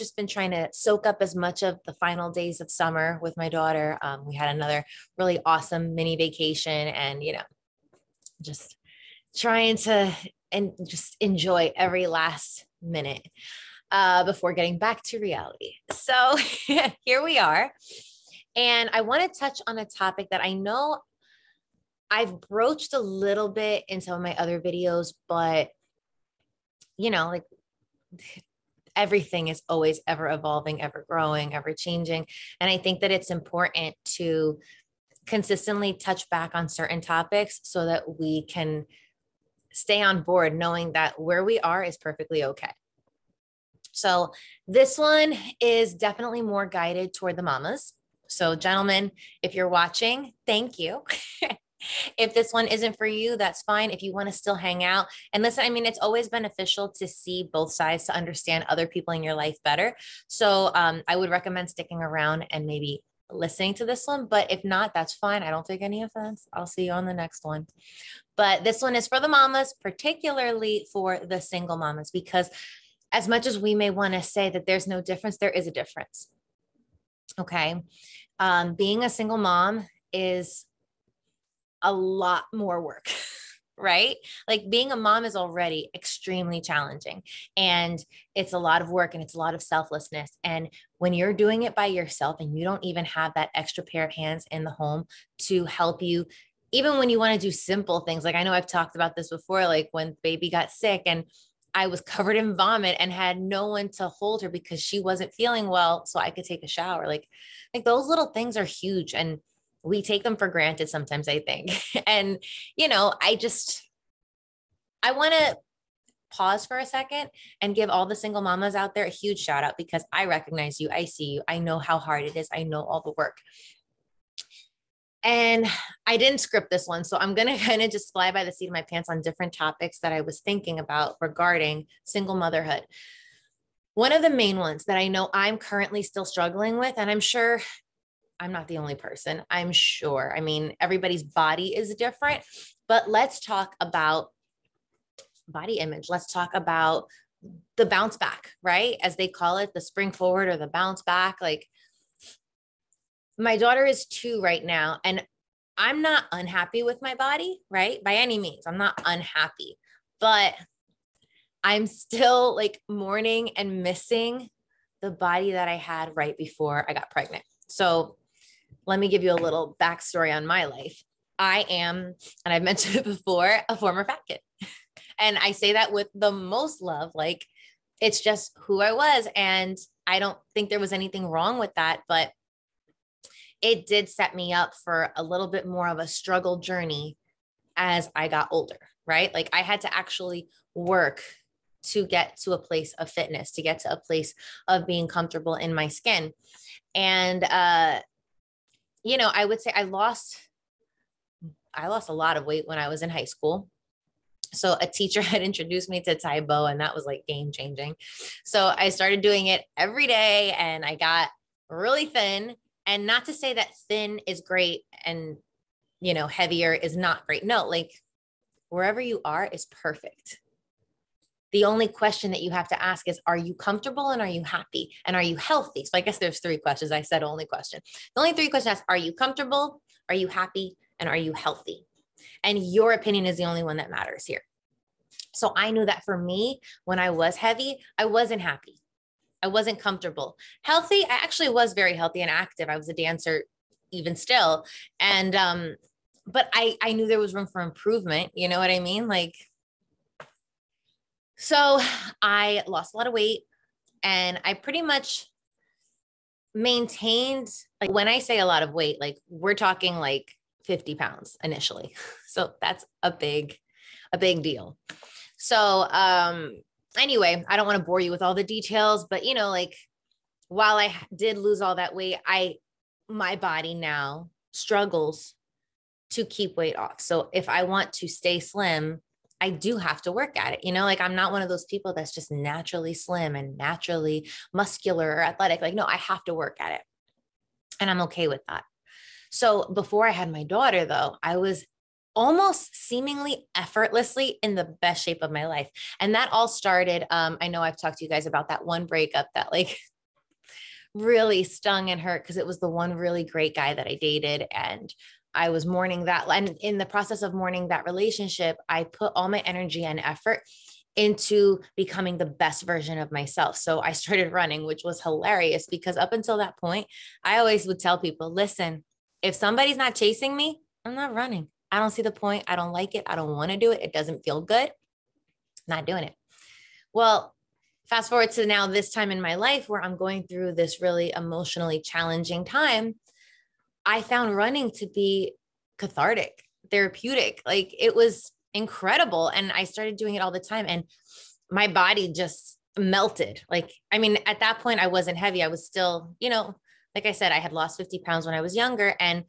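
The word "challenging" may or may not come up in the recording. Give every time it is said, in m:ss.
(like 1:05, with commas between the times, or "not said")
1:26, 5:31.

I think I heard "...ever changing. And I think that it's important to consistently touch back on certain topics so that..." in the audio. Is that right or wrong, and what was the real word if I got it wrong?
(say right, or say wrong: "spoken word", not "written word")
right.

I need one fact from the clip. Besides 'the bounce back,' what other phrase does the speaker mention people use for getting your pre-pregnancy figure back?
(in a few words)
The spring forward.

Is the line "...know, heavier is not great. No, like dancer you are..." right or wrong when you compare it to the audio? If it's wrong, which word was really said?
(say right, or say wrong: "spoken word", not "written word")
wrong: "wherever", not "dancer".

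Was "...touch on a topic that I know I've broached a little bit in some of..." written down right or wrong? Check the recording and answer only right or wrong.
right.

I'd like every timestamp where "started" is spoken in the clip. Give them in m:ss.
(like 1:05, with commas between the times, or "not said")
3:28, 4:56, 5:13, 5:39.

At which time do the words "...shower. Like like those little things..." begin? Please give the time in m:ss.
1:46.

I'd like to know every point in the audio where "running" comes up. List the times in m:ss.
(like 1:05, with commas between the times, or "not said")
5:14, 5:21, 5:34.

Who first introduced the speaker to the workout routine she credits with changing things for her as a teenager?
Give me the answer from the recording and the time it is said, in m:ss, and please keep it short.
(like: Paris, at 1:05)
A teacher, at 3:24.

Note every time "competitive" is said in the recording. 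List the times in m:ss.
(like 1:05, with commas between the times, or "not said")
not said.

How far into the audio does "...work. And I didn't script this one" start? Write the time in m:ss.
2:03.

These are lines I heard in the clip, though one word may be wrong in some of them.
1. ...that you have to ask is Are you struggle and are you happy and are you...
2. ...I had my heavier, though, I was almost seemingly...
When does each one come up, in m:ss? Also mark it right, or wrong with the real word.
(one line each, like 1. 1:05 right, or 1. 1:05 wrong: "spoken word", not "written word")
1. 3:42 wrong: "comfortable", not "struggle"
2. 4:50 wrong: "daughter", not "heavier".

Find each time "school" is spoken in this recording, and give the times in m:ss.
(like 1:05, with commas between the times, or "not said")
3:23.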